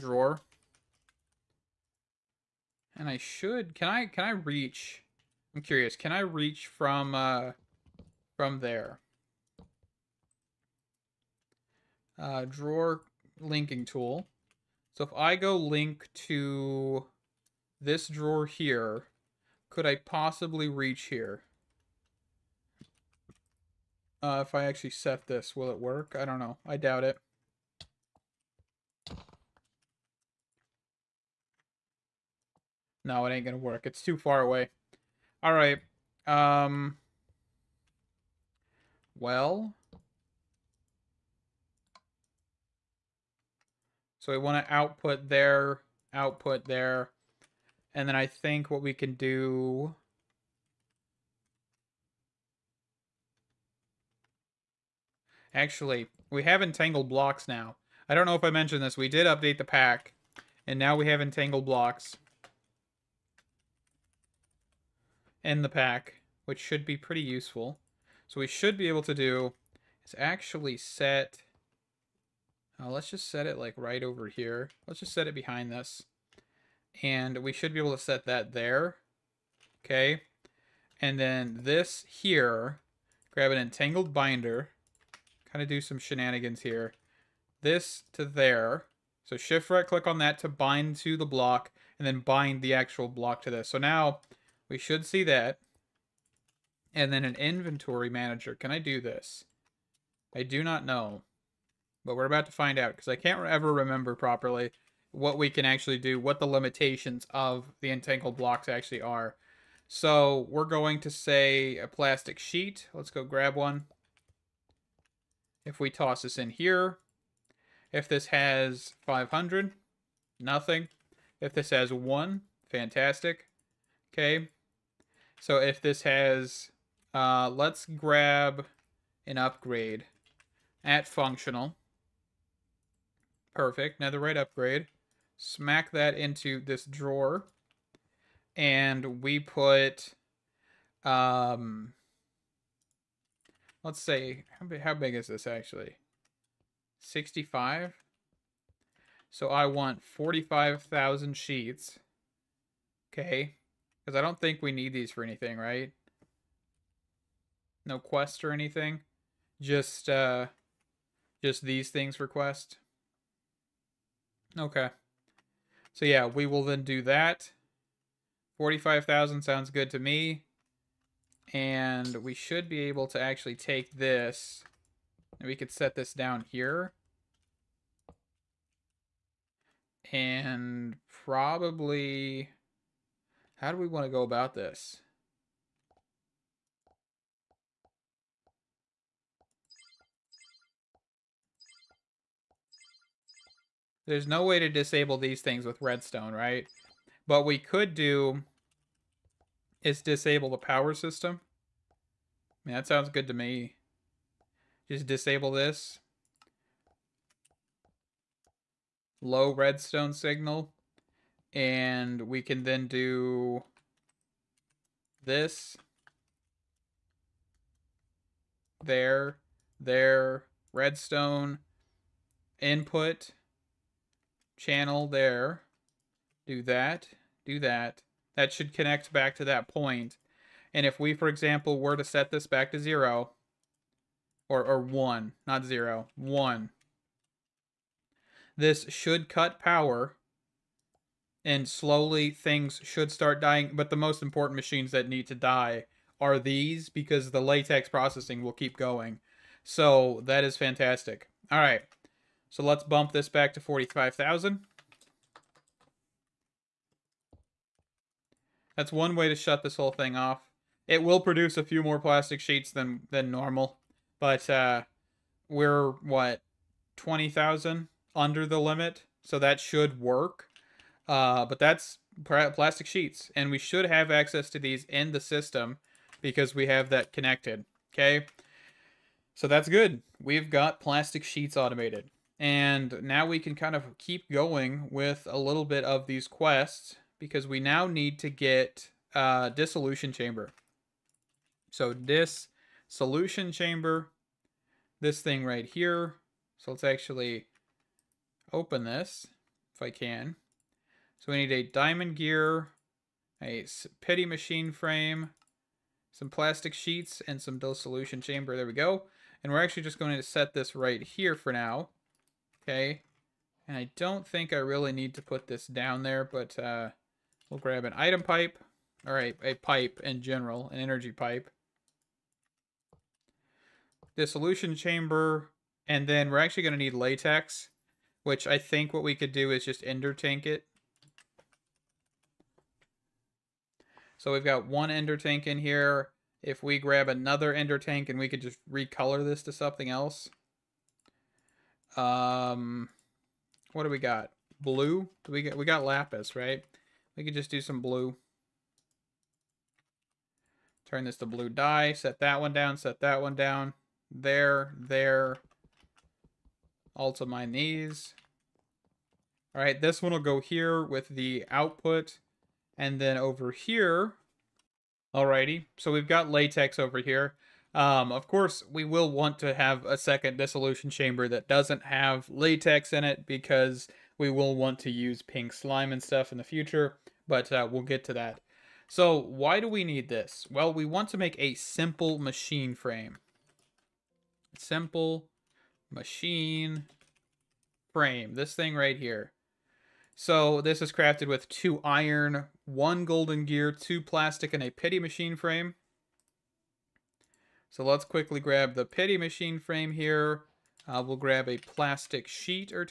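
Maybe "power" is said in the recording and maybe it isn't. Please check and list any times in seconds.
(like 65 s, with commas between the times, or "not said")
200 s, 239 s.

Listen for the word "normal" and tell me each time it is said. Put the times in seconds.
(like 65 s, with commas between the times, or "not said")
263 s.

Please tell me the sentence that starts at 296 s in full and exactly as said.
So let's actually open this if I can.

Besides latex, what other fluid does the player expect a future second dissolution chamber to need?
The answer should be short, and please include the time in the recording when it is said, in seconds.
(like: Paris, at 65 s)
Pink slime, at 375 s.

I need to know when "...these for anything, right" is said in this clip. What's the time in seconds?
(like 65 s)
154 s.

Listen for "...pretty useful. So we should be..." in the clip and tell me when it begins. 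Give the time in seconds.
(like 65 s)
66 s.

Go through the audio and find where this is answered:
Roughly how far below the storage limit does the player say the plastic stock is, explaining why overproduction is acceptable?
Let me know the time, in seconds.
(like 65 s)
266 s.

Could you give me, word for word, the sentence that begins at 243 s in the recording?
But the most important machines that need to die are these because the latex processing will keep going.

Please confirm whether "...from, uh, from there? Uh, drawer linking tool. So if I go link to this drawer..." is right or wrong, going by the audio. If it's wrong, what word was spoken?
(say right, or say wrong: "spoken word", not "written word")
right.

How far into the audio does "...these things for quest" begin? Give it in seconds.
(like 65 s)
161 s.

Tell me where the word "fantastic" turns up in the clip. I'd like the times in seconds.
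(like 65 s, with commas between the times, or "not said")
122 s, 250 s.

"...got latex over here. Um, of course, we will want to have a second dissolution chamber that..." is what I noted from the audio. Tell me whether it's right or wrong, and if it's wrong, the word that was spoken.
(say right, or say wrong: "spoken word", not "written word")
right.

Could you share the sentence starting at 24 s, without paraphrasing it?
Uh, if I actually set this, will it work?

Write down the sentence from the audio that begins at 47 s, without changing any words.
And then I think what we can do...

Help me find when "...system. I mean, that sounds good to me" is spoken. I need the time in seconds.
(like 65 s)
200 s.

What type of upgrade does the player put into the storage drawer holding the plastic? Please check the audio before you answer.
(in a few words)
Netherite upgrade.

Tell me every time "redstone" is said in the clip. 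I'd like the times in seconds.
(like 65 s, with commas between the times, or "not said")
195 s, 209 s, 220 s.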